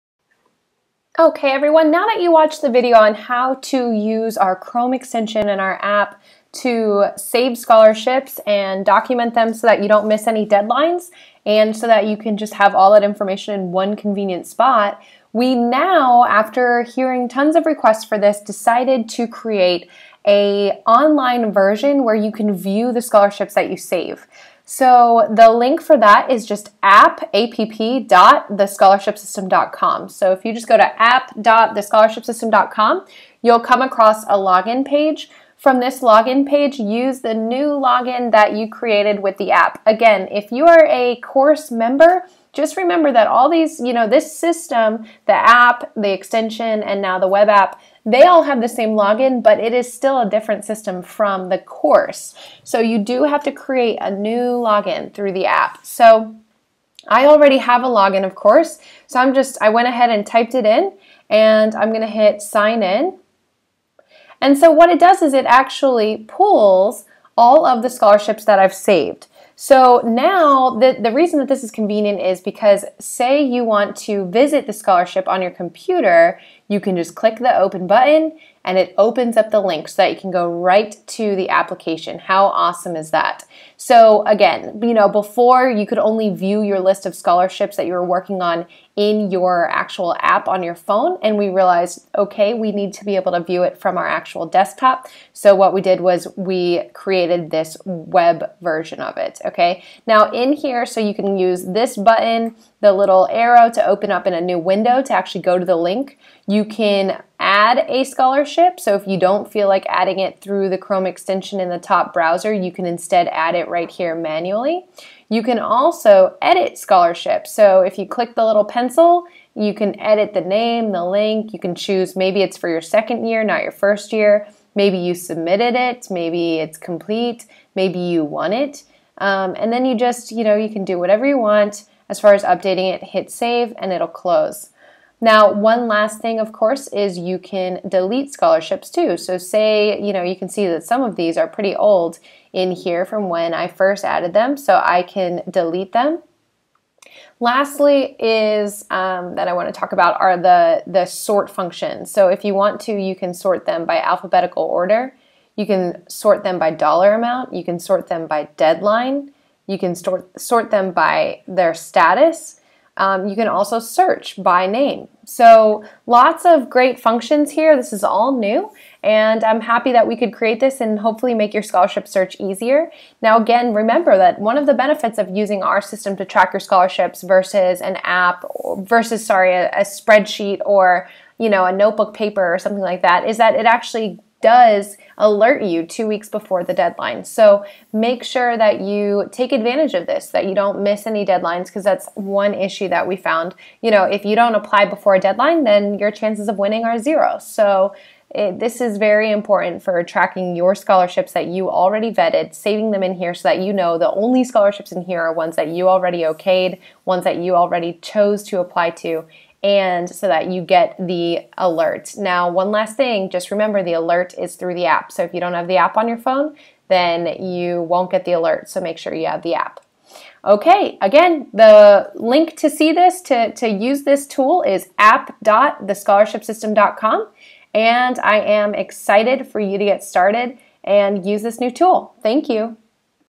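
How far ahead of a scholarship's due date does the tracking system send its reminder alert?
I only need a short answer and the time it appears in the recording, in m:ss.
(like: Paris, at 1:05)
2 weeks, at 3:05.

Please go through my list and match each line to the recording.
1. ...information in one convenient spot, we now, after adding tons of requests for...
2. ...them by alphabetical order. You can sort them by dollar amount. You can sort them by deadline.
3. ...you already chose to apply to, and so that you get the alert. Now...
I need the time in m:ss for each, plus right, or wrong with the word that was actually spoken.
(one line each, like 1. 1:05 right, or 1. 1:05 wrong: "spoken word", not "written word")
1. 0:13 wrong: "hearing", not "adding"
2. 2:33 right
3. 3:27 right.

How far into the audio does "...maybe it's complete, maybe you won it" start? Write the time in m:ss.
2:06.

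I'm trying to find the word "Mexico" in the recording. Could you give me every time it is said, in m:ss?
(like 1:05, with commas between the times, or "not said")
not said.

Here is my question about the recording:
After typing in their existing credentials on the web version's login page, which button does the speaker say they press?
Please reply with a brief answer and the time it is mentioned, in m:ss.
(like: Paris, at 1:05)
sign in, at 1:02.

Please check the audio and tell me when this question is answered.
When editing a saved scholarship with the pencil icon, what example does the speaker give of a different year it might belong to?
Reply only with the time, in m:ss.
2:02.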